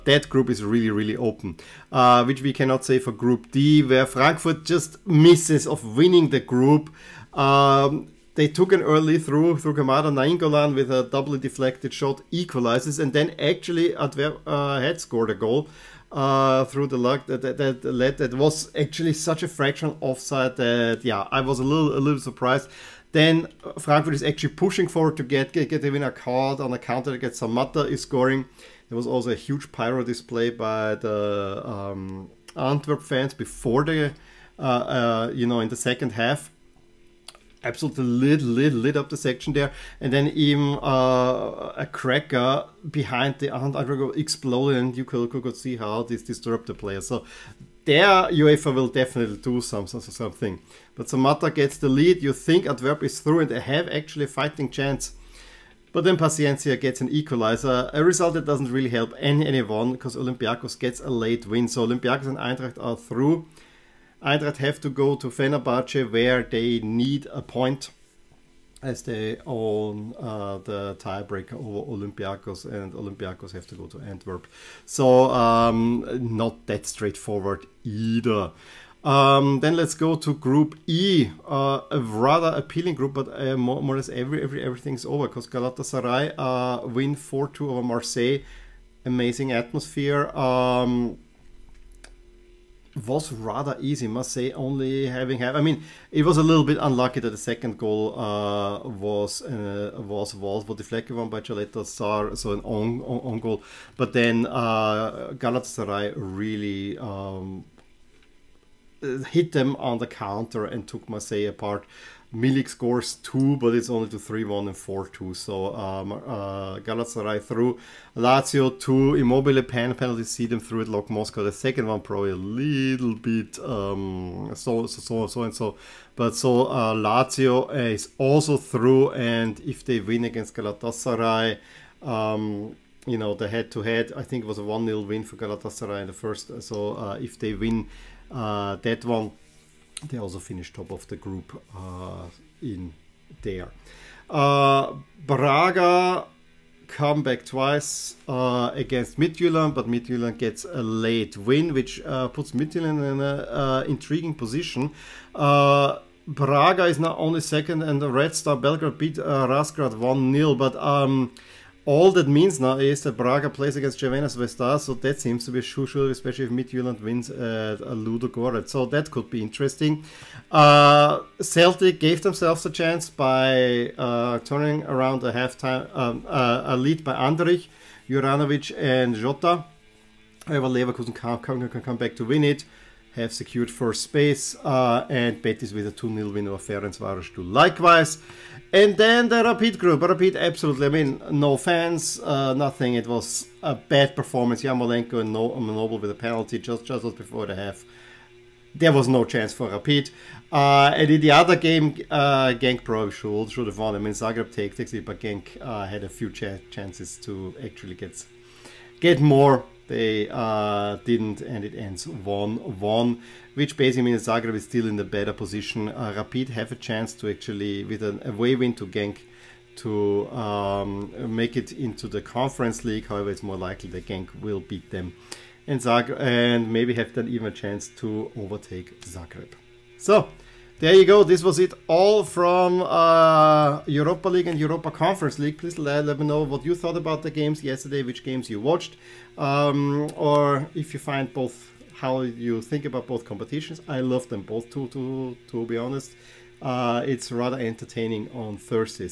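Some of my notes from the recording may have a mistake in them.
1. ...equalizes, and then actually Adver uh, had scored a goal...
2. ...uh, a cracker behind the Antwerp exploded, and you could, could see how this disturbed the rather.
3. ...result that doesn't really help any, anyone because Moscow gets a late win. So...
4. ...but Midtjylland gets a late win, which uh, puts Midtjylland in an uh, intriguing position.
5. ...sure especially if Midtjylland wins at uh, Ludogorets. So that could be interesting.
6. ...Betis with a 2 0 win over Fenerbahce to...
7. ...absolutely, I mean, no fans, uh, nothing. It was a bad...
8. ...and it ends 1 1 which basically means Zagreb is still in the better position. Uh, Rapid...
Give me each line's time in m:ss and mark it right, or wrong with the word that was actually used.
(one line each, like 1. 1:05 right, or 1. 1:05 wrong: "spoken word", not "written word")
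1. 0:12 right
2. 0:40 wrong: "player", not "rather"
3. 0:58 wrong: "Olympiacos", not "Moscow"
4. 2:29 right
5. 2:45 right
6. 3:05 wrong: "Ferencvaros", not "Fenerbahce"
7. 3:10 right
8. 3:31 right.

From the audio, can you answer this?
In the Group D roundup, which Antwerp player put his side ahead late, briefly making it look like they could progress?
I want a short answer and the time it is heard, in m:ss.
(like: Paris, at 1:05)
Samatta, at 0:51.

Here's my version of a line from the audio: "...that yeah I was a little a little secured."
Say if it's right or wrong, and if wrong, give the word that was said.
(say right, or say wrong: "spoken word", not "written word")
wrong: "surprised", not "secured".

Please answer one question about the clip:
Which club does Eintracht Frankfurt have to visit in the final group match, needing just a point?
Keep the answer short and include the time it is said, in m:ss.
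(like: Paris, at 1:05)
Fenerbahce, at 1:05.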